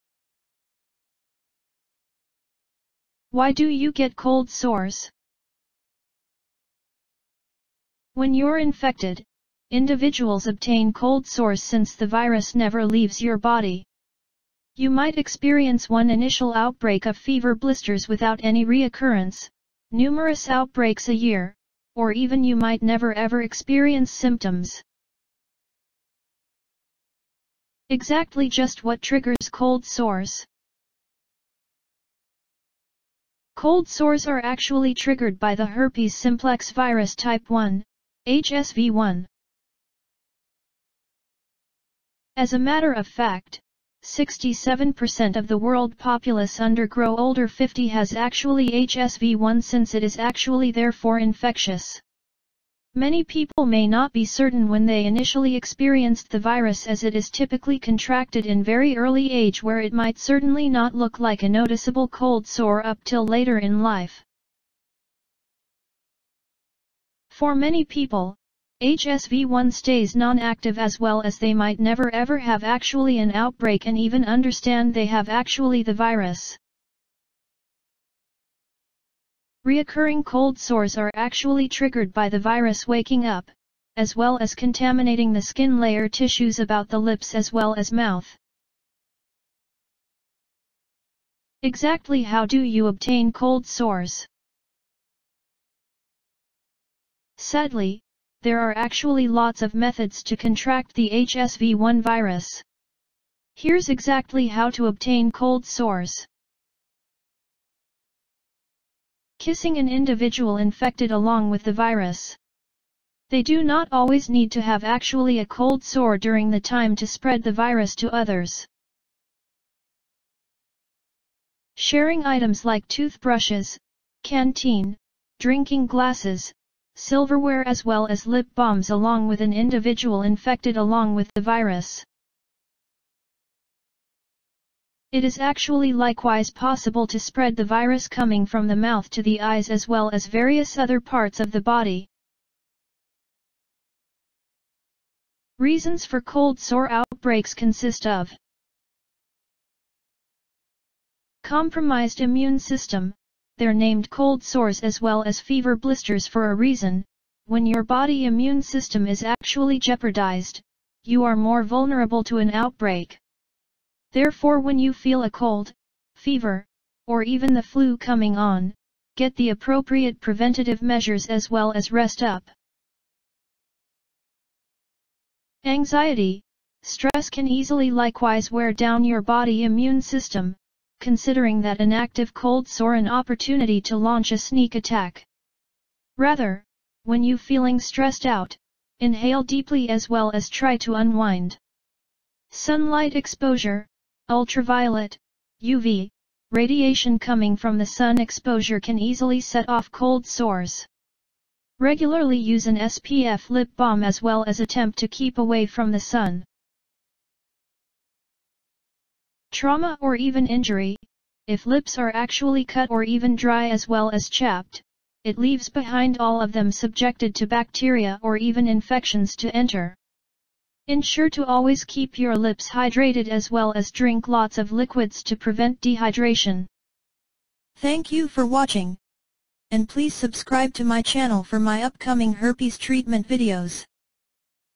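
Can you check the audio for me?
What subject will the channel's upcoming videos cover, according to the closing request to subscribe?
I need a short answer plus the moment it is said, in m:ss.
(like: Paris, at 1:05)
Herpes treatment, at 3:52.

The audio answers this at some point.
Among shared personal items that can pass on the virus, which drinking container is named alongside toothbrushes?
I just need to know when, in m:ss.
2:04.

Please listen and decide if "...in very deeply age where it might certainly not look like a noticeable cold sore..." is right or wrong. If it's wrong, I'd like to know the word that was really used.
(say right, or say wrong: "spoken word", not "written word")
wrong: "early", not "deeply".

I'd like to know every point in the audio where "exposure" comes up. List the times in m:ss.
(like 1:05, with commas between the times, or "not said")
3:13, 3:18.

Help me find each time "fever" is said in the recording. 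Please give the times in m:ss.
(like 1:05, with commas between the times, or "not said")
0:17, 2:35, 2:46.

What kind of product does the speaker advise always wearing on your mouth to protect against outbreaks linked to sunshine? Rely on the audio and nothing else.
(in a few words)
SPF lip balm.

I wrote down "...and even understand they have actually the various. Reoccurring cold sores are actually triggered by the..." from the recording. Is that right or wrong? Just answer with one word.
wrong.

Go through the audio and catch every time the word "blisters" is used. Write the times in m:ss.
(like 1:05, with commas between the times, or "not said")
0:17, 2:35.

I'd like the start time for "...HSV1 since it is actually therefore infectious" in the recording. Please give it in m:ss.
0:48.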